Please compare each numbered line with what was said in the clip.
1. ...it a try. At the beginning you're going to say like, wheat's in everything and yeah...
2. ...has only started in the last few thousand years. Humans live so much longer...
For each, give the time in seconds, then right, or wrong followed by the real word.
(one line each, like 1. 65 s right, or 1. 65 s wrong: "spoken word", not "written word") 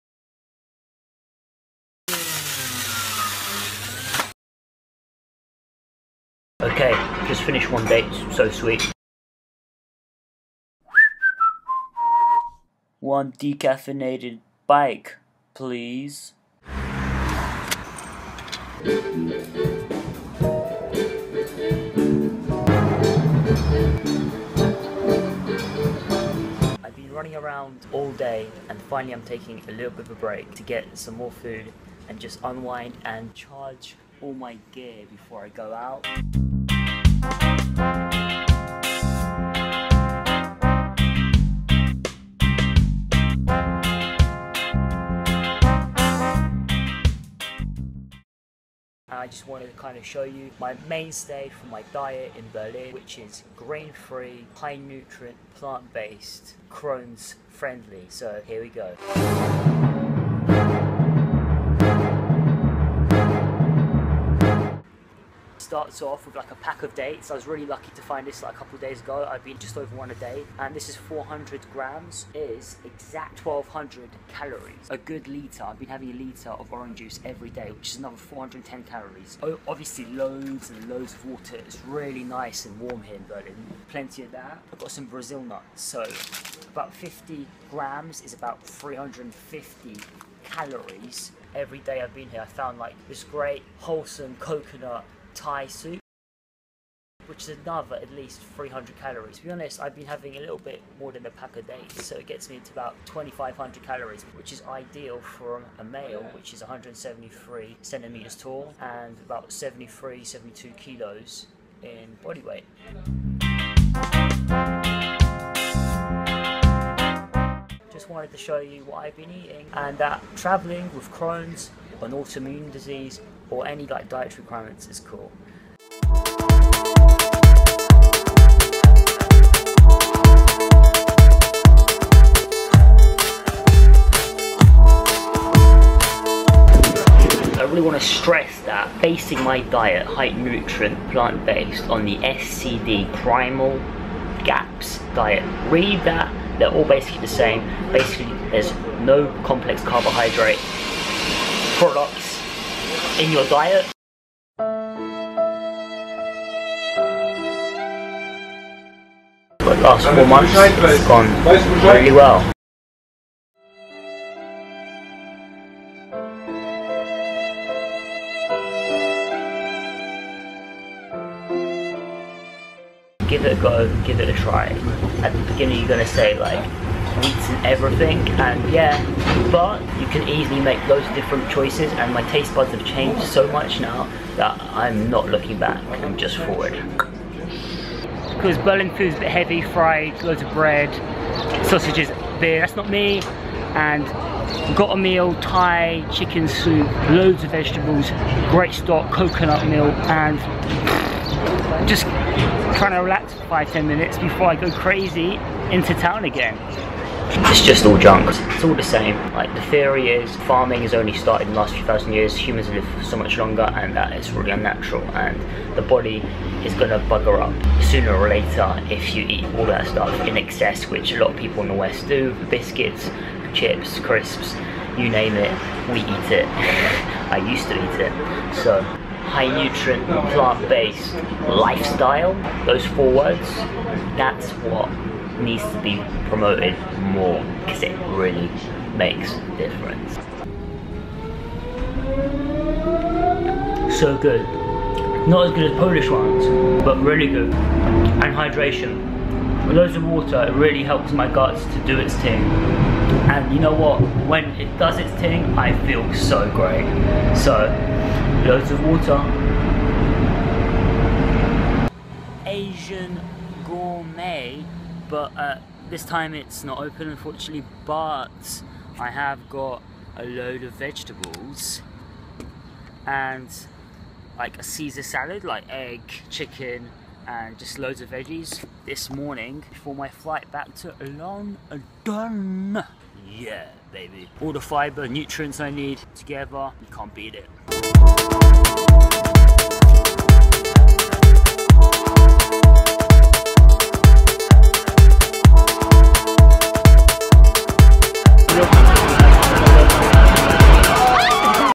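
1. 174 s right
2. 210 s right.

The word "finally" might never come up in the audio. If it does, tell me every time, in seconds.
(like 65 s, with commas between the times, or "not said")
28 s.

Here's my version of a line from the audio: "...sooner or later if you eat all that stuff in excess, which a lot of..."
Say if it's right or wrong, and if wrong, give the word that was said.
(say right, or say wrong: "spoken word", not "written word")
right.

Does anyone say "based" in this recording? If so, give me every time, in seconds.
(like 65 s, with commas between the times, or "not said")
55 s, 141 s, 230 s.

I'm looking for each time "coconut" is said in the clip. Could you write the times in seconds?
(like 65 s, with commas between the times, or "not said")
94 s, 199 s.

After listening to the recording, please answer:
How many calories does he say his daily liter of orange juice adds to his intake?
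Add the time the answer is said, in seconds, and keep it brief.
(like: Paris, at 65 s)
410 calories, at 78 s.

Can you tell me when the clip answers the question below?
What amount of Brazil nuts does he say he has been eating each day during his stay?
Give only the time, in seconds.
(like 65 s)
86 s.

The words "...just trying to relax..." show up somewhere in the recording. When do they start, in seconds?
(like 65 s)
201 s.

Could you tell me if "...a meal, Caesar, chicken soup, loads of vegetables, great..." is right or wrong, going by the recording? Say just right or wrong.
wrong.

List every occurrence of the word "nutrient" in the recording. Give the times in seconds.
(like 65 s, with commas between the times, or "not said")
54 s, 140 s, 229 s, 285 s.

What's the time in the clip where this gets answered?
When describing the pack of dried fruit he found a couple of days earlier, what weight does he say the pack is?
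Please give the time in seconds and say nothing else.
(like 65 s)
70 s.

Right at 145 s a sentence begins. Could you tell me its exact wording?
Read that, they're all basically the same.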